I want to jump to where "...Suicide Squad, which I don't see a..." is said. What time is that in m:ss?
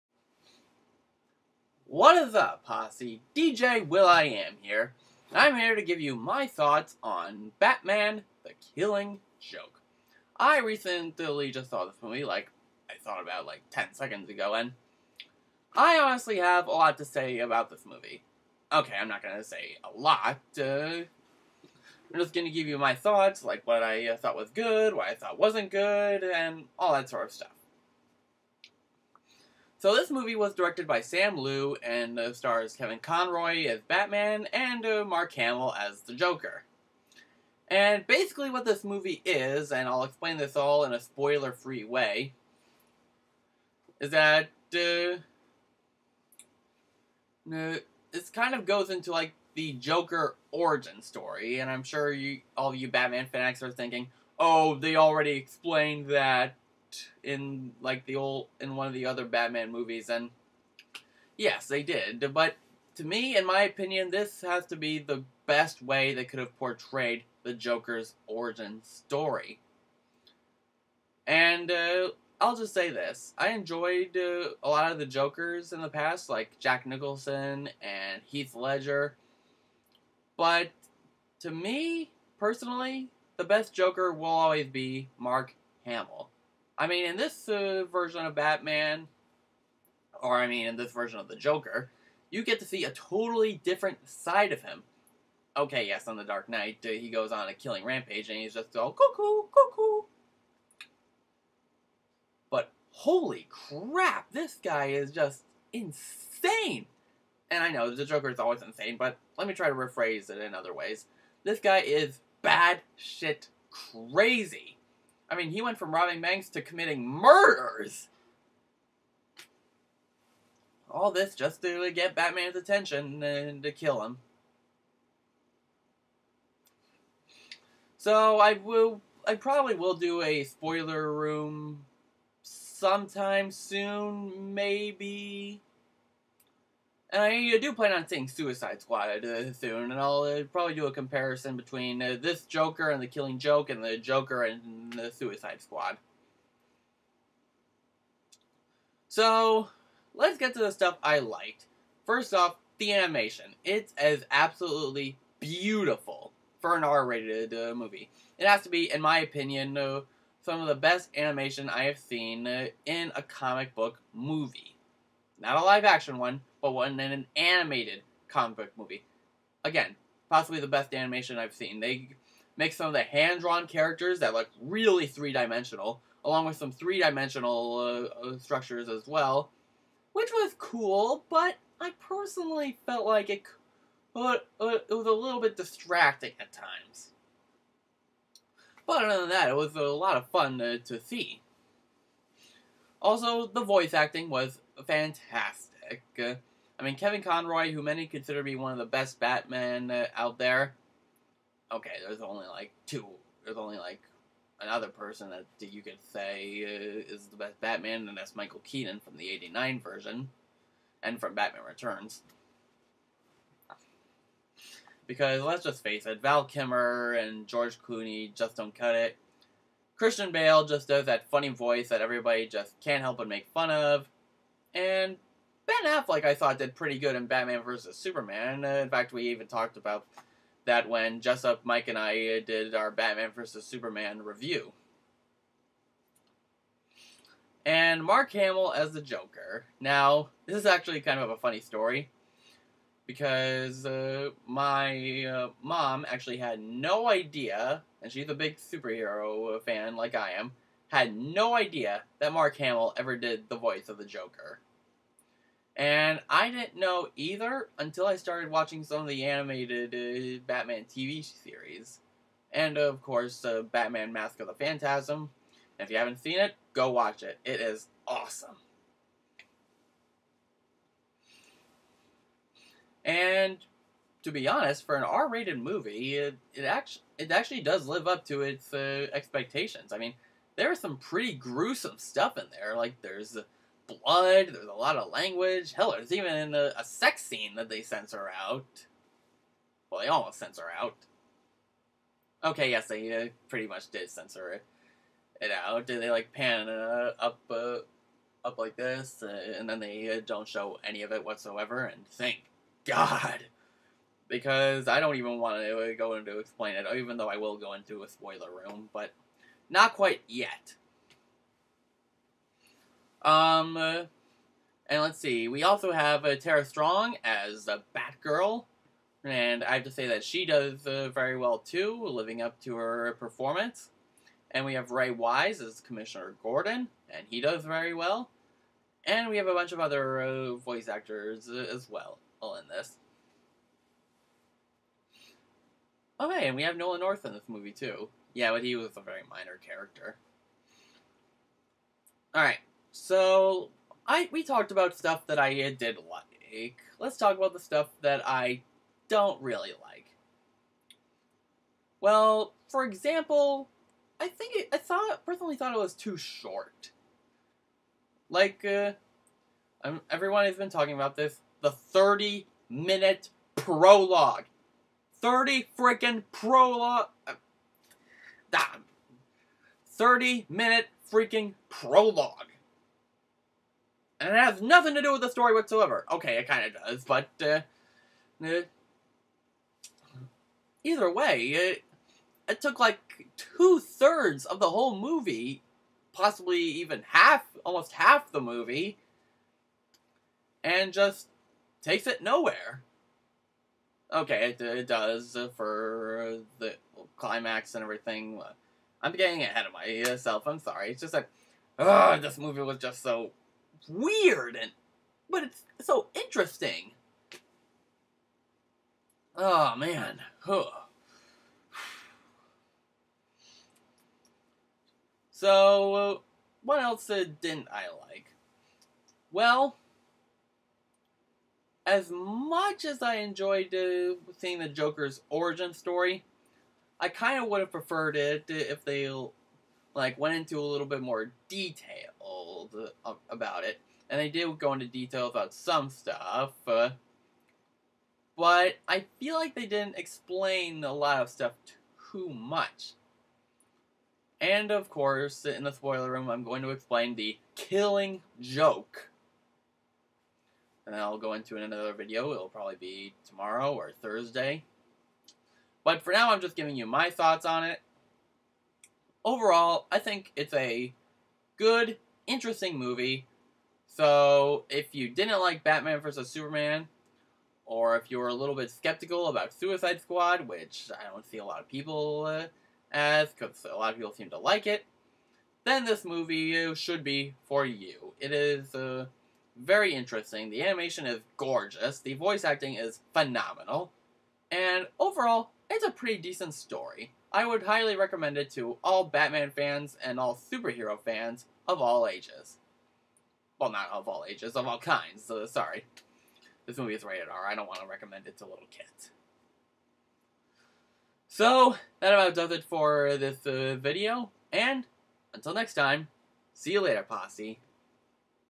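7:49.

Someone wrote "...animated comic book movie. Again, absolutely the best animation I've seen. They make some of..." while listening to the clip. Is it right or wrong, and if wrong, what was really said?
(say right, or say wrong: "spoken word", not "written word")
wrong: "possibly", not "absolutely".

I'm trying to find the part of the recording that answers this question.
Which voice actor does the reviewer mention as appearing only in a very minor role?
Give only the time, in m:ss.
5:36.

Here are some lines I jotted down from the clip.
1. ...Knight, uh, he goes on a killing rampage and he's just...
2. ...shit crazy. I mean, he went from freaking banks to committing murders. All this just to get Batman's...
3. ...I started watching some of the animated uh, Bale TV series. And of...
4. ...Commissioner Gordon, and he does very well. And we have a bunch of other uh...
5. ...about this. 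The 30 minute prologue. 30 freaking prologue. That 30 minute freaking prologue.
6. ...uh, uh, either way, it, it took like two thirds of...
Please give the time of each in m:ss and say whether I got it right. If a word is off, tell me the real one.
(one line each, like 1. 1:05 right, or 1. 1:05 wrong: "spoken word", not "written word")
1. 1:36 right
2. 1:52 wrong: "robbing", not "freaking"
3. 4:18 wrong: "Batman", not "Bale"
4. 5:25 right
5. 6:00 right
6. 6:17 right.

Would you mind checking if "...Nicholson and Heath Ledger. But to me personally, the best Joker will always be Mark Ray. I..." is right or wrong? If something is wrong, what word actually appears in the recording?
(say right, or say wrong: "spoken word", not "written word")
wrong: "Hamill", not "Ray".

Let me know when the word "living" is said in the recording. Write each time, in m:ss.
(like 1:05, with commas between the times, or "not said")
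5:22.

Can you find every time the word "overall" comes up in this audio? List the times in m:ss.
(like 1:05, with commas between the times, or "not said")
7:39, 8:04.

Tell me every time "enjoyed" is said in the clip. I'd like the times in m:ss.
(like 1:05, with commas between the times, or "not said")
1:13, 7:03.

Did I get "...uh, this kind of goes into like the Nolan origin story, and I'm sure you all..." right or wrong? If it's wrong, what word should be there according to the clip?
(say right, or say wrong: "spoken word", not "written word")
wrong: "Joker", not "Nolan".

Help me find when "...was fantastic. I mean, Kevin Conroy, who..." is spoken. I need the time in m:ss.
3:14.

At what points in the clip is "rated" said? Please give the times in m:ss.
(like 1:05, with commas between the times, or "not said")
2:36, 4:35, 8:17.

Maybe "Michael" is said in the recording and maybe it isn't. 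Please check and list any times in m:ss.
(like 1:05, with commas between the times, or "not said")
3:28.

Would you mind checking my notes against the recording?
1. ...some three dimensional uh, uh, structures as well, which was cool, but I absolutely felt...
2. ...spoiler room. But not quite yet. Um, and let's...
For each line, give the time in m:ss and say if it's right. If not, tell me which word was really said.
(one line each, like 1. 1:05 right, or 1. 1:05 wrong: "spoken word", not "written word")
1. 2:56 wrong: "personally", not "absolutely"
2. 5:08 right.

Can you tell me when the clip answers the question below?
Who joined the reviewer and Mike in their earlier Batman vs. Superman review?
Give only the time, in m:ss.
3:51.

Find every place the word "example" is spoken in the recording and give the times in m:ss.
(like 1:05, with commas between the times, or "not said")
5:52.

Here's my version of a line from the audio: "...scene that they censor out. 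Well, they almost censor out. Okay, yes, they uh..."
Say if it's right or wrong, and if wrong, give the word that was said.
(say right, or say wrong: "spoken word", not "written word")
right.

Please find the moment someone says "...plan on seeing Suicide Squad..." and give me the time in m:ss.
2:17.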